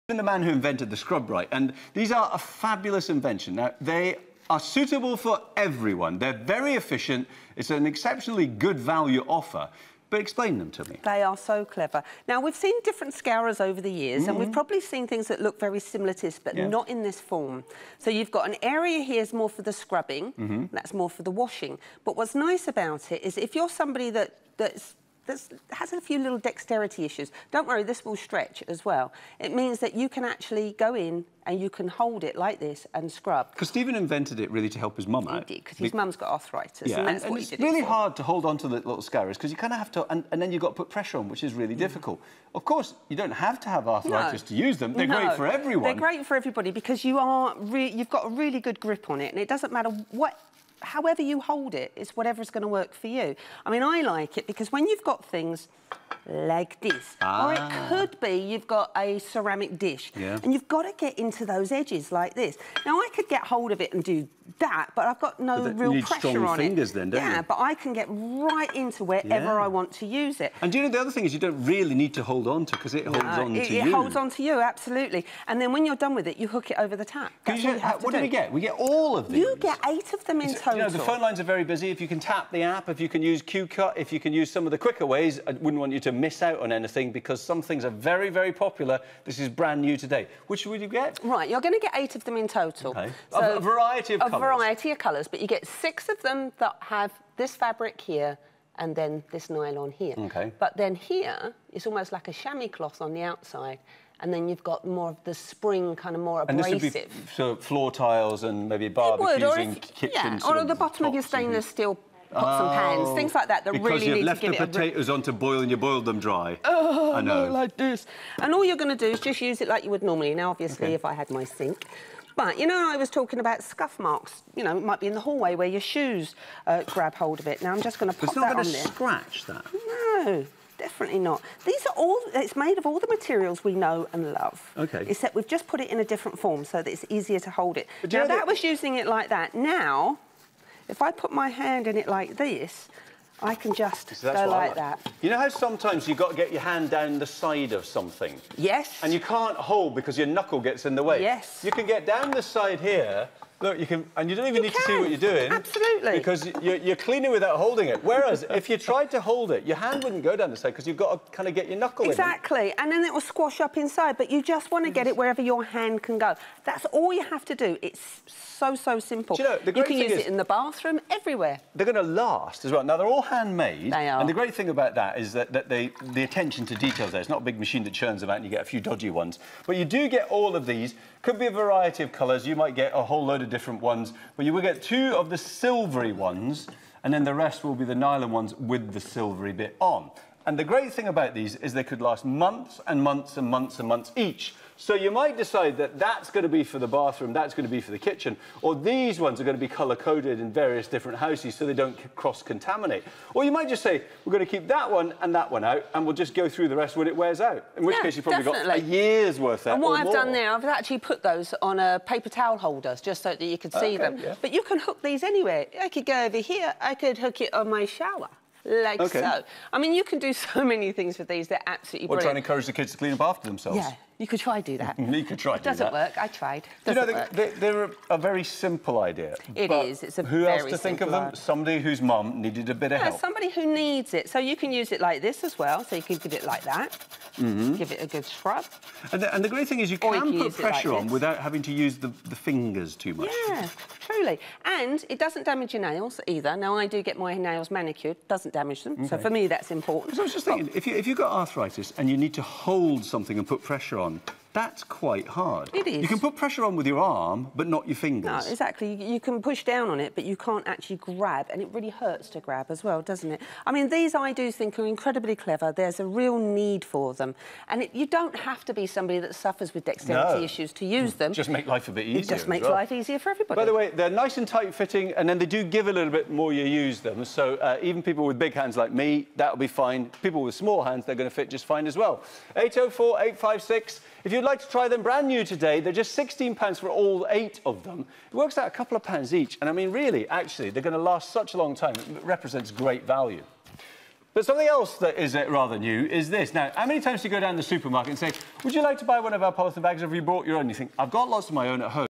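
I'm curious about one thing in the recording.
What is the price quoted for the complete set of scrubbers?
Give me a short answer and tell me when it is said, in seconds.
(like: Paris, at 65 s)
£16, at 286 s.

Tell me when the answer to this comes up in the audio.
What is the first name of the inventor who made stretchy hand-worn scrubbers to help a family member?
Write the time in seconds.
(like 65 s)
33 s.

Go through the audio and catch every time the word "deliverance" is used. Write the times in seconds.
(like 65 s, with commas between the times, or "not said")
not said.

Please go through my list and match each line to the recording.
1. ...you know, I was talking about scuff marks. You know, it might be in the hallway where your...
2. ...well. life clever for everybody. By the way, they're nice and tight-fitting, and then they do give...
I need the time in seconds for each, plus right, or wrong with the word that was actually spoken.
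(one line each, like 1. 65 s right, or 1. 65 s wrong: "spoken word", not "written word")
1. 122 s right
2. 272 s wrong: "easier", not "clever".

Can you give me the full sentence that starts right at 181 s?
Could be a variety of colours.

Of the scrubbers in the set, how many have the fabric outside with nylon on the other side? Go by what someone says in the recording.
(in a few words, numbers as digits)
6.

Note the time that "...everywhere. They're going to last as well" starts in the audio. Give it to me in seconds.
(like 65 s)
171 s.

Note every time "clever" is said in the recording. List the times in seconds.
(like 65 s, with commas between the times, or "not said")
11 s, 265 s.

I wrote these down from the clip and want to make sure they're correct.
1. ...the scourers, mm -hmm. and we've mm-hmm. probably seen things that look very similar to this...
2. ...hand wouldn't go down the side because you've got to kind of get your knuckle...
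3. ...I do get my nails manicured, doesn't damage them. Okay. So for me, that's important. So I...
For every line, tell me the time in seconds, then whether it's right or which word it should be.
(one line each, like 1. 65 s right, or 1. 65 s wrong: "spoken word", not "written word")
1. 13 s wrong: "years", not "scourers"
2. 159 s right
3. 246 s right.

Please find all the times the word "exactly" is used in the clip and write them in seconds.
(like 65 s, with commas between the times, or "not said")
162 s, 258 s.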